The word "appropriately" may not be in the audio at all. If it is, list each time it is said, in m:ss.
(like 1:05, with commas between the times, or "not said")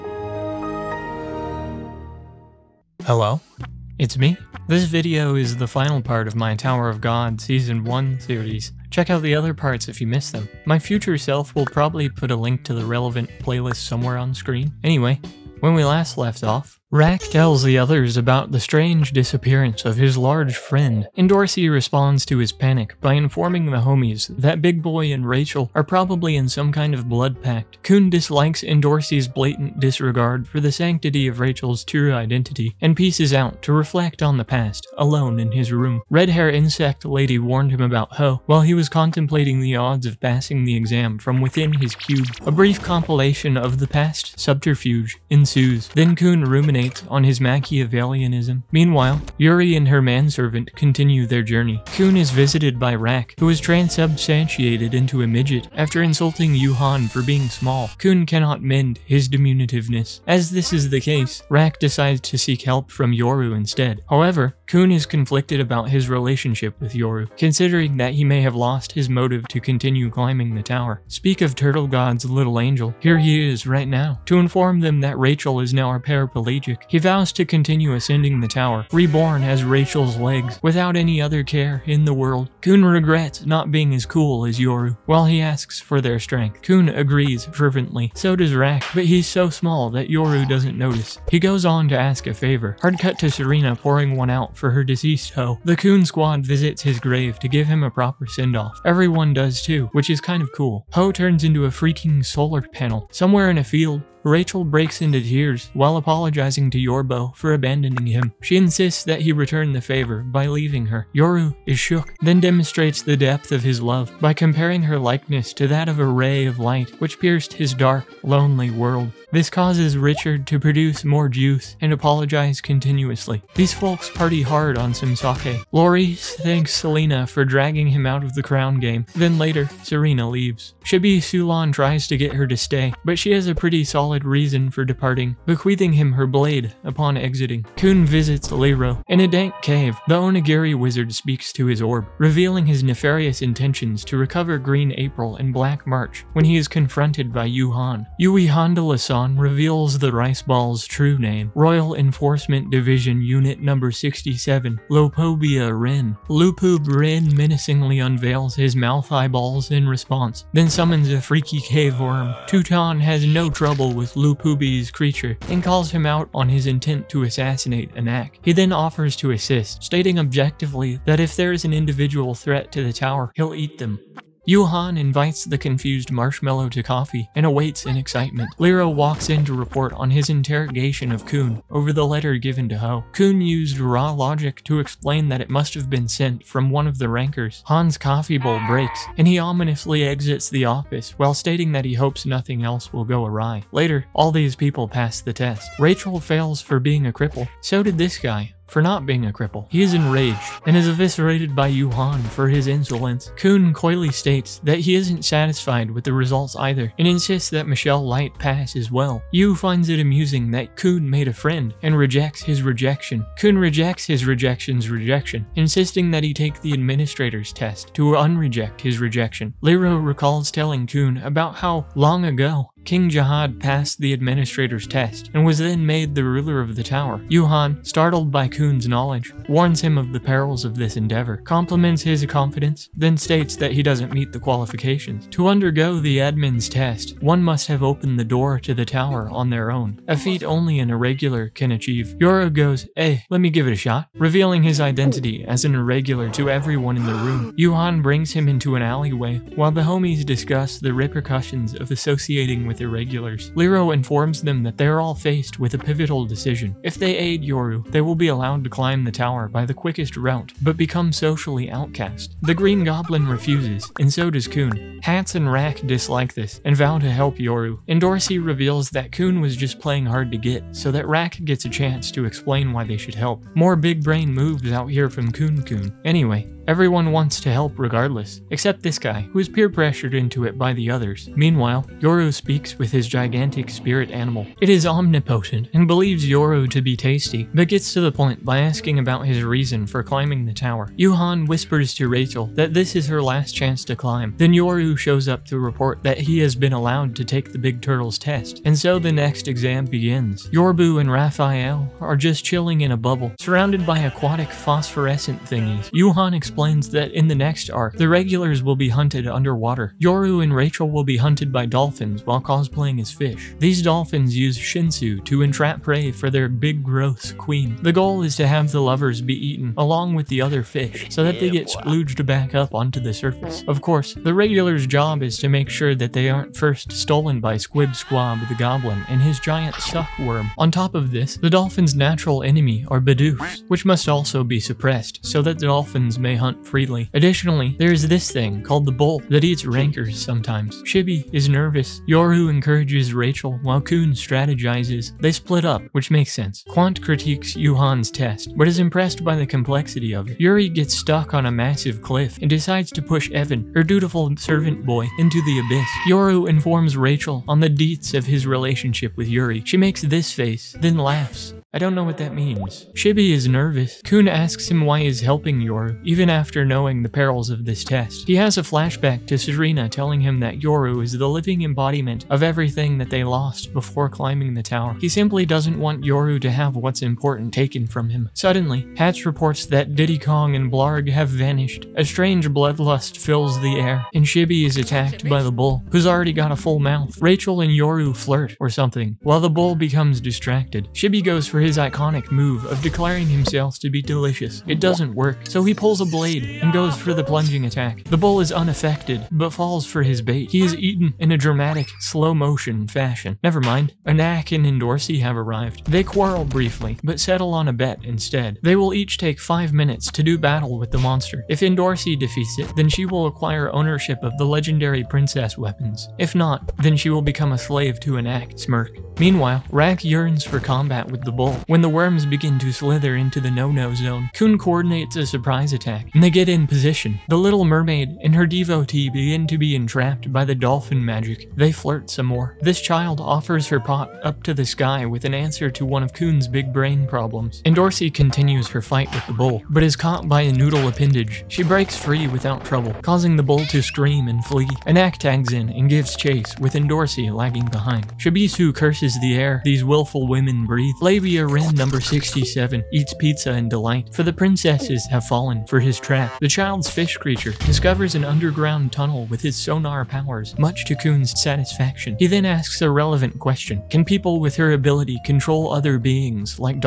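not said.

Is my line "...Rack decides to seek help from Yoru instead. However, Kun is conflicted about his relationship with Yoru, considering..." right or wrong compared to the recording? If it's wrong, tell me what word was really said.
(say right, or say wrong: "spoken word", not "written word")
right.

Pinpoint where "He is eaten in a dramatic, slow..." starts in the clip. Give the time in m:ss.
6:40.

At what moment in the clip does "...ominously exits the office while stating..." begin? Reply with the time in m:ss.
3:09.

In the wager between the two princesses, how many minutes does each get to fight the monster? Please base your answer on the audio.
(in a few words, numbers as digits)
5.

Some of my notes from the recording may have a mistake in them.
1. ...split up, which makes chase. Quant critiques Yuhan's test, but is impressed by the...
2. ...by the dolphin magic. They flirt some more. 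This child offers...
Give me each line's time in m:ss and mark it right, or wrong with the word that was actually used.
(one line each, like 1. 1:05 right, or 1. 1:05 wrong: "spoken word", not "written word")
1. 5:45 wrong: "sense", not "chase"
2. 7:10 right.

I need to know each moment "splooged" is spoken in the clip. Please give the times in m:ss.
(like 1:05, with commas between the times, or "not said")
5:21.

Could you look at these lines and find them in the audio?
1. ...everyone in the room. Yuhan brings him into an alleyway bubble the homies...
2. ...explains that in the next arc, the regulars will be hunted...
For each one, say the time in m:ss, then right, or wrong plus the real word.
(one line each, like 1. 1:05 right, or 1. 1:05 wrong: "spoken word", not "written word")
1. 4:06 wrong: "while", not "bubble"
2. 5:06 right.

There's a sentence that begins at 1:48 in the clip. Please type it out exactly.
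She insists that he return the favor by leaving her.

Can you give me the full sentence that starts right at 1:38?
Everyone does too, which is kind of cool.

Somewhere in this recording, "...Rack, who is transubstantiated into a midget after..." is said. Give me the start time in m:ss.
0:52.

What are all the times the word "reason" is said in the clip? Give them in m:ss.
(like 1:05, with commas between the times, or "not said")
2:14, 4:49.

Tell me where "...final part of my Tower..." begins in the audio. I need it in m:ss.
0:05.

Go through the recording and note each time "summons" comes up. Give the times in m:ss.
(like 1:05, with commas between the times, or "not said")
2:40.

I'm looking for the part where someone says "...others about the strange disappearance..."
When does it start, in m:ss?
0:17.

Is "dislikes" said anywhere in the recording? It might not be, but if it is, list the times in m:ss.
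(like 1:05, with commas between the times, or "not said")
0:28, 4:25.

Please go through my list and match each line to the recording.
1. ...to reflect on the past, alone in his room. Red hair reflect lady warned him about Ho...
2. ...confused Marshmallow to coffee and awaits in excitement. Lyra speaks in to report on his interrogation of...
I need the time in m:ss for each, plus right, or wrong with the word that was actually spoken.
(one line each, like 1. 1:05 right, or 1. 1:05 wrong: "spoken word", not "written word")
1. 0:33 wrong: "insect", not "reflect"
2. 2:55 wrong: "walks", not "speaks".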